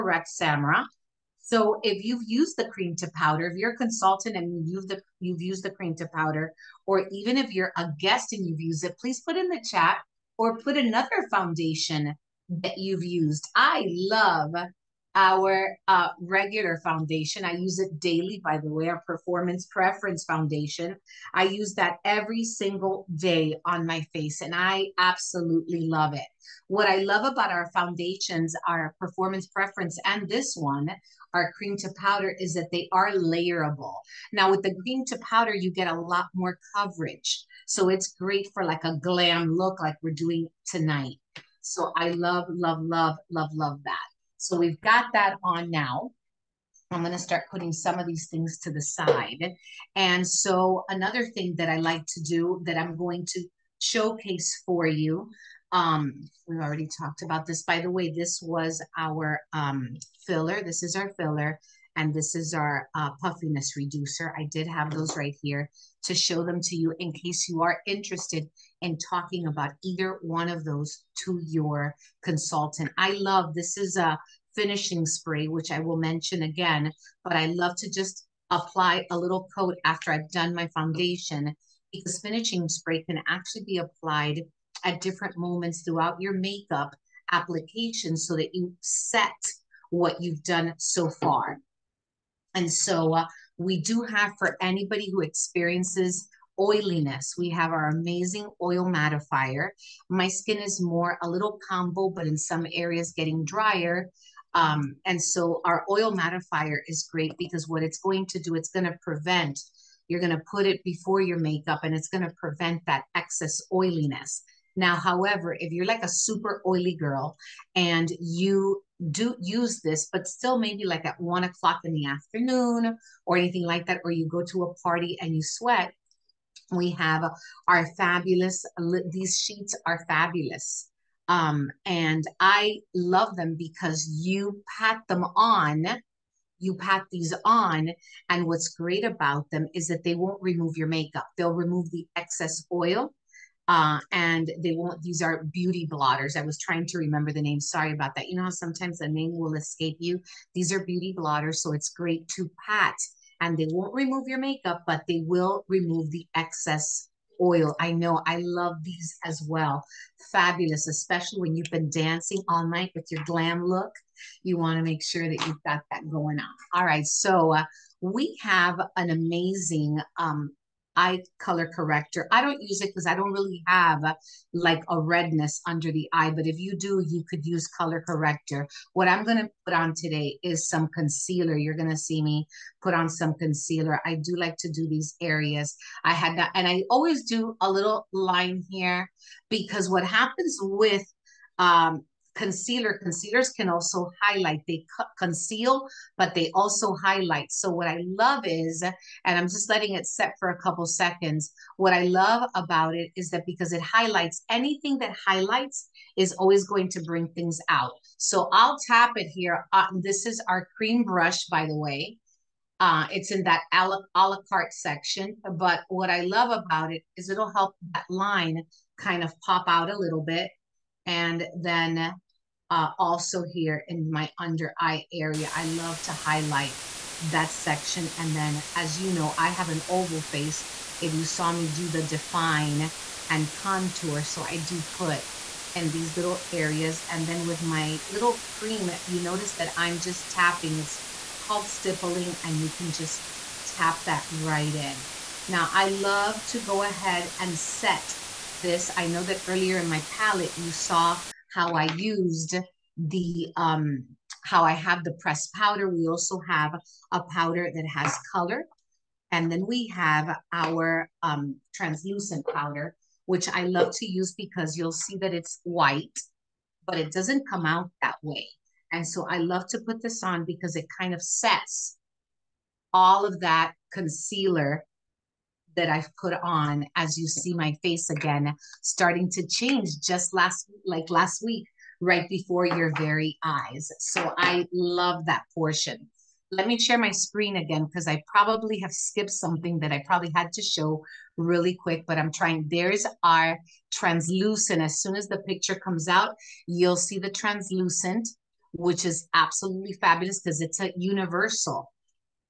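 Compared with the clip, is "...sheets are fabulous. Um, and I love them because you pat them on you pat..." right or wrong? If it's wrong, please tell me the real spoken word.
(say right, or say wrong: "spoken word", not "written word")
right.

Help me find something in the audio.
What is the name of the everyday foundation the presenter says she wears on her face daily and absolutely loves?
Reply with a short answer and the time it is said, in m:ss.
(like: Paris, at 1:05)
performance preference foundation, at 0:19.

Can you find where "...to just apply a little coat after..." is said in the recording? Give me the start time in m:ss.
1:17.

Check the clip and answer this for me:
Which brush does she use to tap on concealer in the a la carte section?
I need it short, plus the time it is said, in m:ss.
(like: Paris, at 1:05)
cream brush, at 3:30.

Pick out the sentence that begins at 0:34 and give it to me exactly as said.
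Now, with the cream to powder, you get a lot more coverage.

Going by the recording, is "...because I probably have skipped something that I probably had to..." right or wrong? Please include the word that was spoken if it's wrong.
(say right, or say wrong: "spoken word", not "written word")
right.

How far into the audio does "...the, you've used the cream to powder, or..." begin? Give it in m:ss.
0:04.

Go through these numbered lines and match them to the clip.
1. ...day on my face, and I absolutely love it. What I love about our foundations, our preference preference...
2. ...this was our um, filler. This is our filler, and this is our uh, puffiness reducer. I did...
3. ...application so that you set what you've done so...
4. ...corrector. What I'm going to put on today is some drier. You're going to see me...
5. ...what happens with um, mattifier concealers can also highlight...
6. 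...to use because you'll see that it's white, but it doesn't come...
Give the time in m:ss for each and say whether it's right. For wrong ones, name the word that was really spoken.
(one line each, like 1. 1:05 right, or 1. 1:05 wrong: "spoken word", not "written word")
1. 0:23 wrong: "performance", not "preference"
2. 0:58 right
3. 1:27 right
4. 2:58 wrong: "concealer", not "drier"
5. 3:09 wrong: "concealer", not "mattifier"
6. 4:23 right.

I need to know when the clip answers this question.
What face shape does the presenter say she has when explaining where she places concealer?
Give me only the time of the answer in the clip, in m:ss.
3:49.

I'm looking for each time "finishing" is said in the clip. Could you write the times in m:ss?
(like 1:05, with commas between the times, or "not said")
1:14, 1:22.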